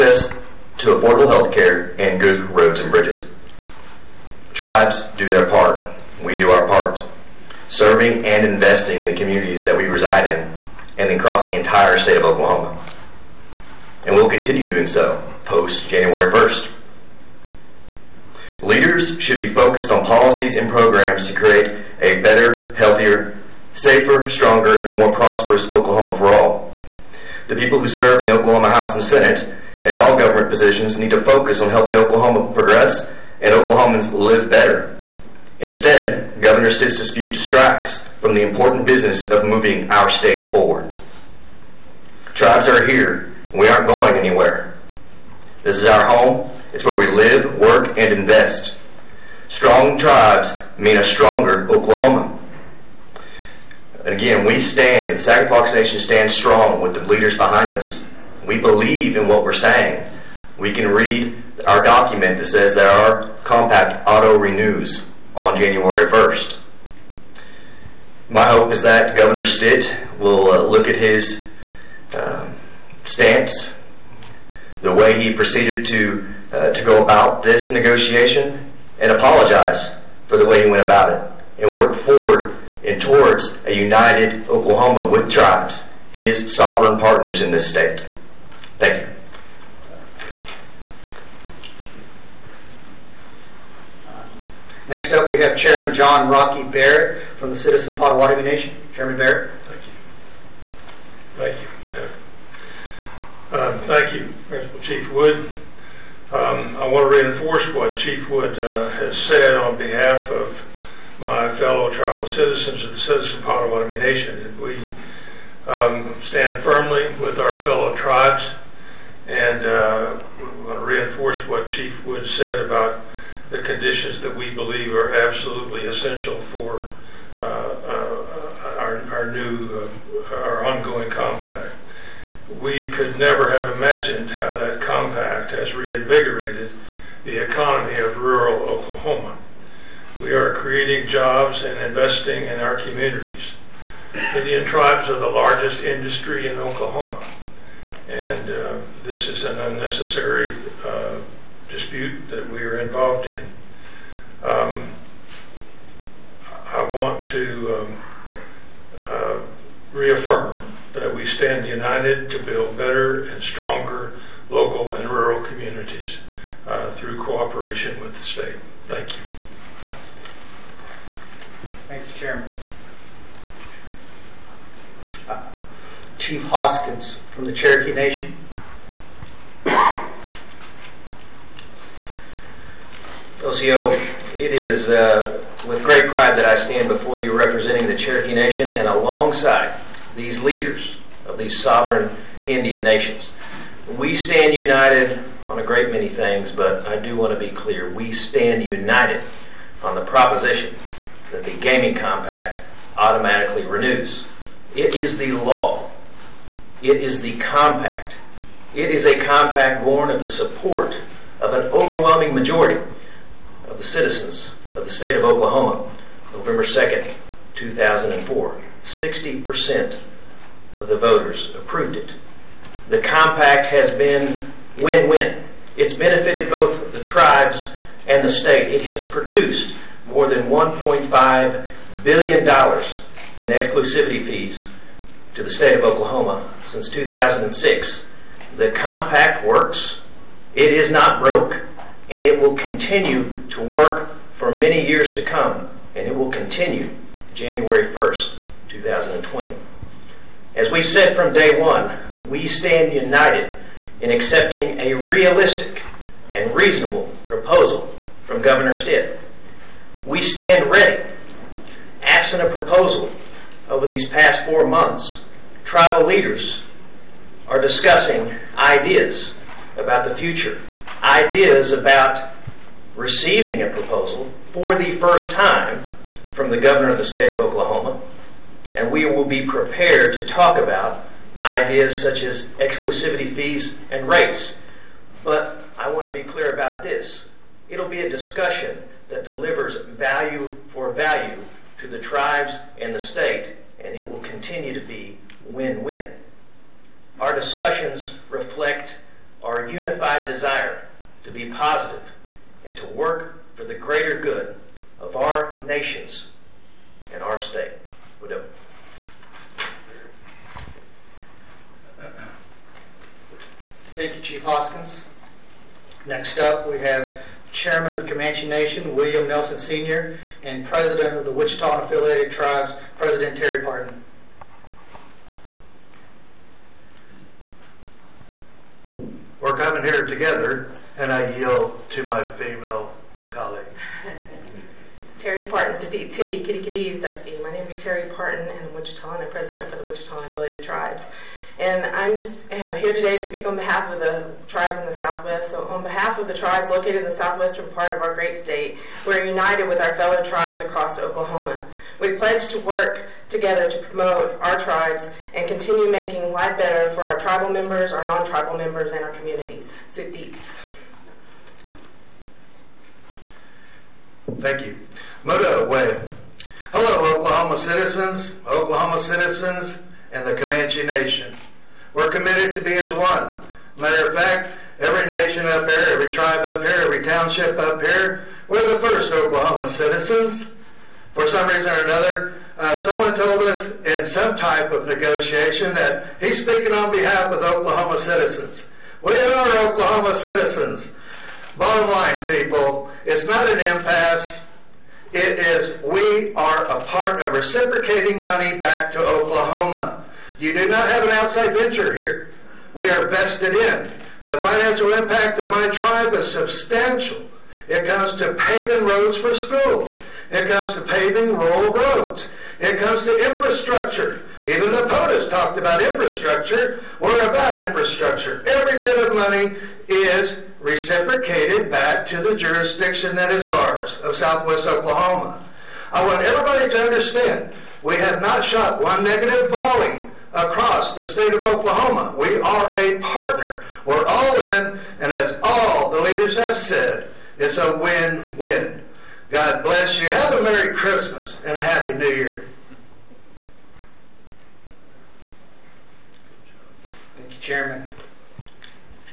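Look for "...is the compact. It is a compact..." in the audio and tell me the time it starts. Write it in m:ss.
3:26.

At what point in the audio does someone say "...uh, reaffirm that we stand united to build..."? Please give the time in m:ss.
2:39.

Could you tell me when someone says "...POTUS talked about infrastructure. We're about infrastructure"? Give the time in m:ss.
6:54.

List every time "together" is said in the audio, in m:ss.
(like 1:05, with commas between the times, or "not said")
5:30, 5:53.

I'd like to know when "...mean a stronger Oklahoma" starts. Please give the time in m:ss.
0:50.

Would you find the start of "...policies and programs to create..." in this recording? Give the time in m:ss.
0:20.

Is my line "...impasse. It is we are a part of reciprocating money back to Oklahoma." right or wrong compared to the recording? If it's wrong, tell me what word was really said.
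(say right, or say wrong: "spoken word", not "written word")
right.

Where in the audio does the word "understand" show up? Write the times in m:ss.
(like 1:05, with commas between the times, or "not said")
7:06.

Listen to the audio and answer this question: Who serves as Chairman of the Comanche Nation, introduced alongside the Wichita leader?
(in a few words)
William Nelson Sr.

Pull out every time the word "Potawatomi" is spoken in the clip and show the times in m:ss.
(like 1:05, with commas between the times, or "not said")
1:37, 1:53.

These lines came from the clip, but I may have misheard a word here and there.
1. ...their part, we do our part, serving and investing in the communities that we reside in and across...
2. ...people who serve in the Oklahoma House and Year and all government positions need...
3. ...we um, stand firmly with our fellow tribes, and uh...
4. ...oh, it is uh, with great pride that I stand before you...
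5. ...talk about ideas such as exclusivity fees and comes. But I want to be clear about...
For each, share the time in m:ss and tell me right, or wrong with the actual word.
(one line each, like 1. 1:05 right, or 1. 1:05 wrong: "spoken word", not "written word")
1. 0:05 right
2. 0:27 wrong: "Senate", not "Year"
3. 1:54 right
4. 3:03 right
5. 4:40 wrong: "rates", not "comes".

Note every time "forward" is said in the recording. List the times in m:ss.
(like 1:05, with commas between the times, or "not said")
0:40, 1:21.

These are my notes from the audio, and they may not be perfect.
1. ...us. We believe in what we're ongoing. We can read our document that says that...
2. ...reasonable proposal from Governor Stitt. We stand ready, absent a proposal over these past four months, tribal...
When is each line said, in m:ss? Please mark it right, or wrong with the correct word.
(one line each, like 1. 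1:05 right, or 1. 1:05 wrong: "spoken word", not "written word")
1. 0:57 wrong: "saying", not "ongoing"
2. 4:16 right.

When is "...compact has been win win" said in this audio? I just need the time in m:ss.
3:43.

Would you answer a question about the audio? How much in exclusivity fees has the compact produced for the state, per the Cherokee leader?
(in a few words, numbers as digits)
more than $1.5 billion.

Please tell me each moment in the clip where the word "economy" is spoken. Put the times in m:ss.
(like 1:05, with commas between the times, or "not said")
2:17.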